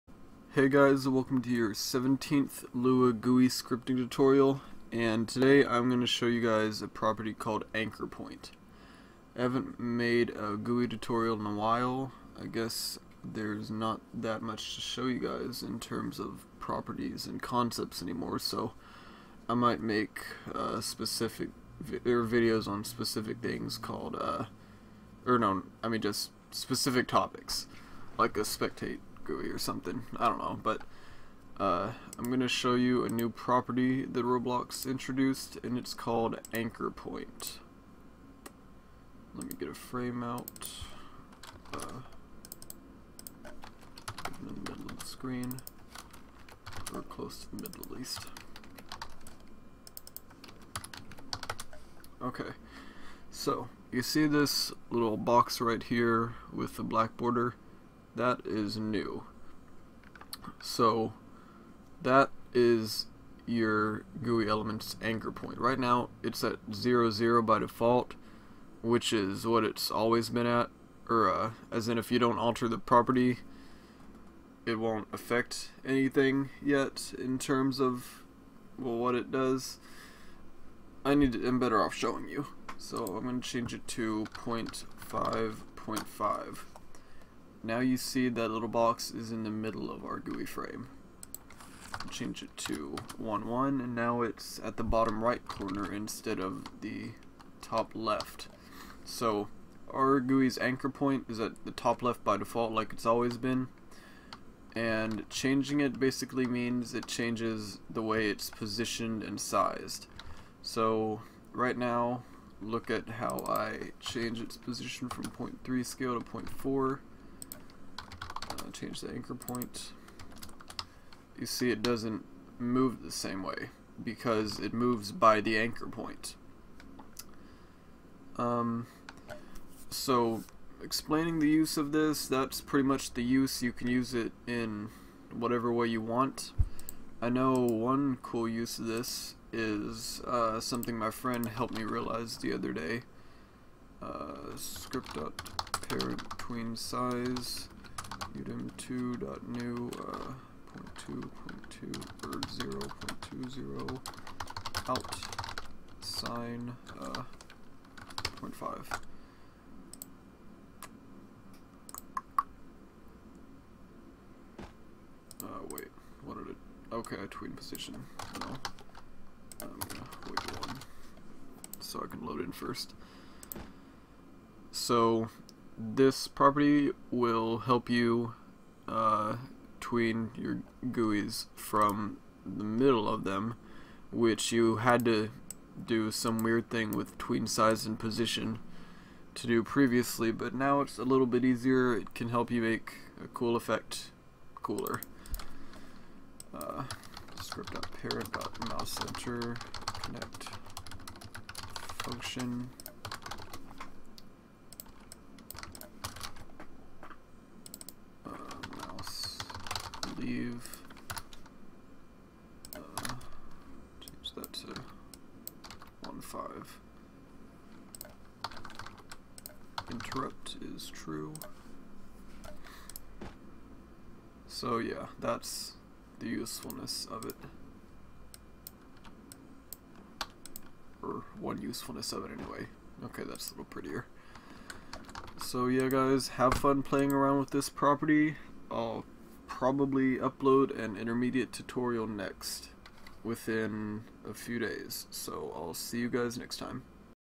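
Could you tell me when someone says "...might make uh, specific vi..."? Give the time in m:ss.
0:19.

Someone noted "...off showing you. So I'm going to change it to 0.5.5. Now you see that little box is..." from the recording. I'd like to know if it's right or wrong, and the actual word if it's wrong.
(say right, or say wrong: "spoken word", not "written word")
right.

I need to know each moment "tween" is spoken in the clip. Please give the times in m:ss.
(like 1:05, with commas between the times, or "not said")
2:26, 2:47, 2:59, 3:07.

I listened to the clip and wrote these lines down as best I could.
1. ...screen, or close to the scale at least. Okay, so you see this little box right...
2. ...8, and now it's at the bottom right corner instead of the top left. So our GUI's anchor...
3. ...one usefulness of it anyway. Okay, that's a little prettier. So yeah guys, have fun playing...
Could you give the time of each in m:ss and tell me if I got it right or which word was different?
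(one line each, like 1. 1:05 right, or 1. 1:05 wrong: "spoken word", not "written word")
1. 0:45 wrong: "middle", not "scale"
2. 1:33 wrong: "1", not "8"
3. 3:51 right.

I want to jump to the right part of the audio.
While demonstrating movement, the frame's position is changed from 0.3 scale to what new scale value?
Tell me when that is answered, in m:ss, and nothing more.
1:56.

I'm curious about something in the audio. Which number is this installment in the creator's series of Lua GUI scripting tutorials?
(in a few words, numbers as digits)
17th.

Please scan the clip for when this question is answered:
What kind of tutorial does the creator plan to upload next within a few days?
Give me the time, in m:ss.
4:00.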